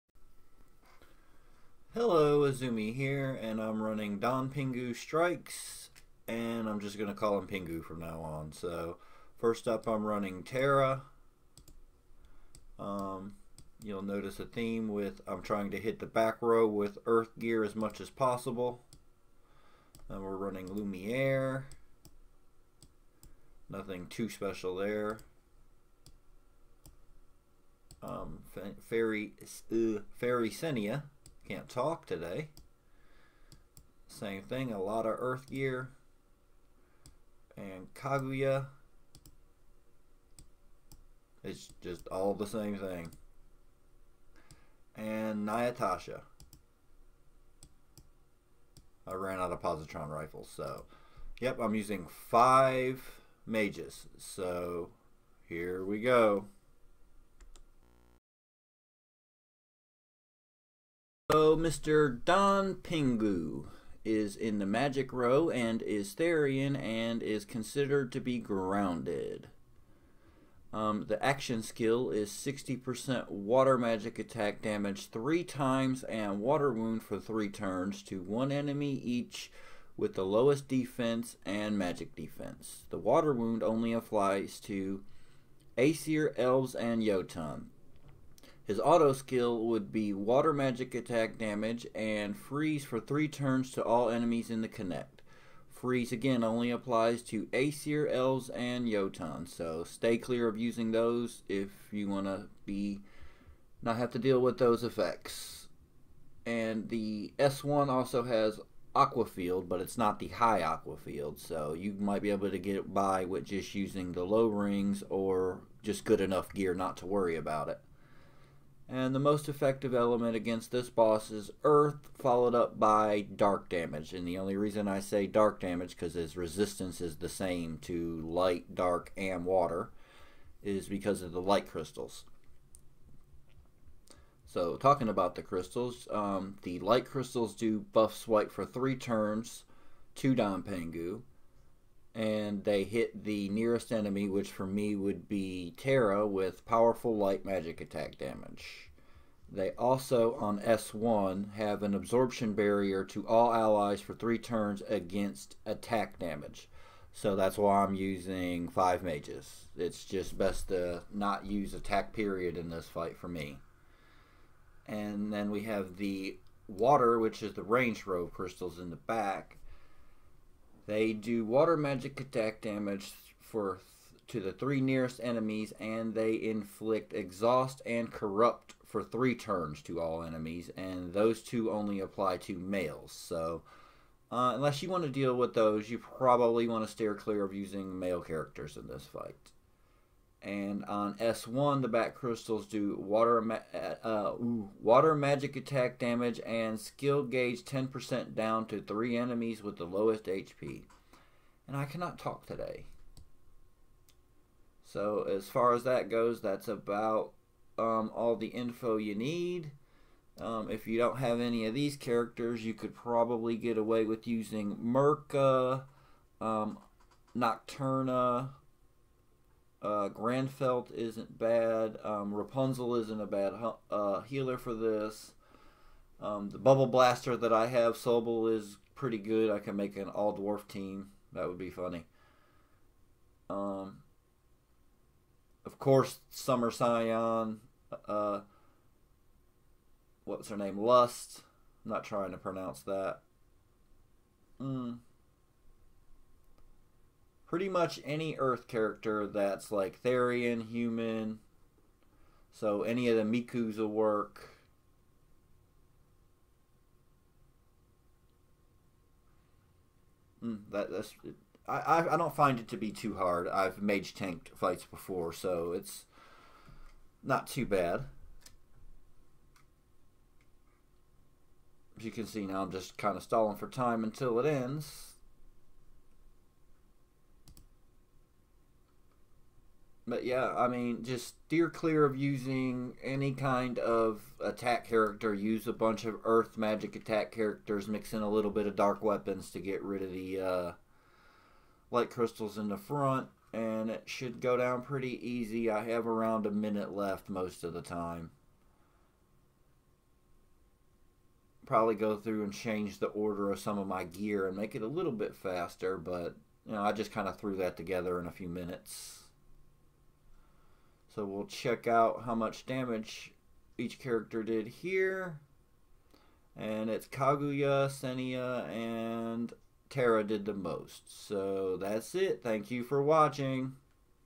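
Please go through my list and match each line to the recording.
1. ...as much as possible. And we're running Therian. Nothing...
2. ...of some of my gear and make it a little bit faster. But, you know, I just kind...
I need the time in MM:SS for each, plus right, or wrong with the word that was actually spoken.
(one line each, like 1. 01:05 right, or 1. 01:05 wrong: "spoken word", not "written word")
1. 00:17 wrong: "Lumiere", not "Therian"
2. 05:03 right.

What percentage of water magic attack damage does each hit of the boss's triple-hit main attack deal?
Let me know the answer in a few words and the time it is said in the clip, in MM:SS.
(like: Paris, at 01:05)
60%, at 01:12.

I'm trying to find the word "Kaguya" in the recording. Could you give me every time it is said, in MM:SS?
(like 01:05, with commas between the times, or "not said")
00:37, 05:17.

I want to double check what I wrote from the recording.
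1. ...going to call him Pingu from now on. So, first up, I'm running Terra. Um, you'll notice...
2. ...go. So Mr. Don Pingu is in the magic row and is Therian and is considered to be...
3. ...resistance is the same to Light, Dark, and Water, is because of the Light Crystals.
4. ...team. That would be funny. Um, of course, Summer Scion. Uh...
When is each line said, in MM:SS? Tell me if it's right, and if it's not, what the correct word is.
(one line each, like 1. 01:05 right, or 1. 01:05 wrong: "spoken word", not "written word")
1. 00:06 right
2. 00:55 right
3. 02:06 right
4. 03:50 right.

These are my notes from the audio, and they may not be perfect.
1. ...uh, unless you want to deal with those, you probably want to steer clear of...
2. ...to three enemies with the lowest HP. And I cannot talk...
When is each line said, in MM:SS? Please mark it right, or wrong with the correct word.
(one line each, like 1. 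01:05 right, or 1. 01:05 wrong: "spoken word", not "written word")
1. 03:04 right
2. 03:18 right.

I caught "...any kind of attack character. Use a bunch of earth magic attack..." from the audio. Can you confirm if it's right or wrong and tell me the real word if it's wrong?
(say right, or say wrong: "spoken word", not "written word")
right.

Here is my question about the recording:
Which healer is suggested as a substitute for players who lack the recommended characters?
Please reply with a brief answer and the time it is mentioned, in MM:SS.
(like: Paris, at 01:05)
Rapunzel, at 03:42.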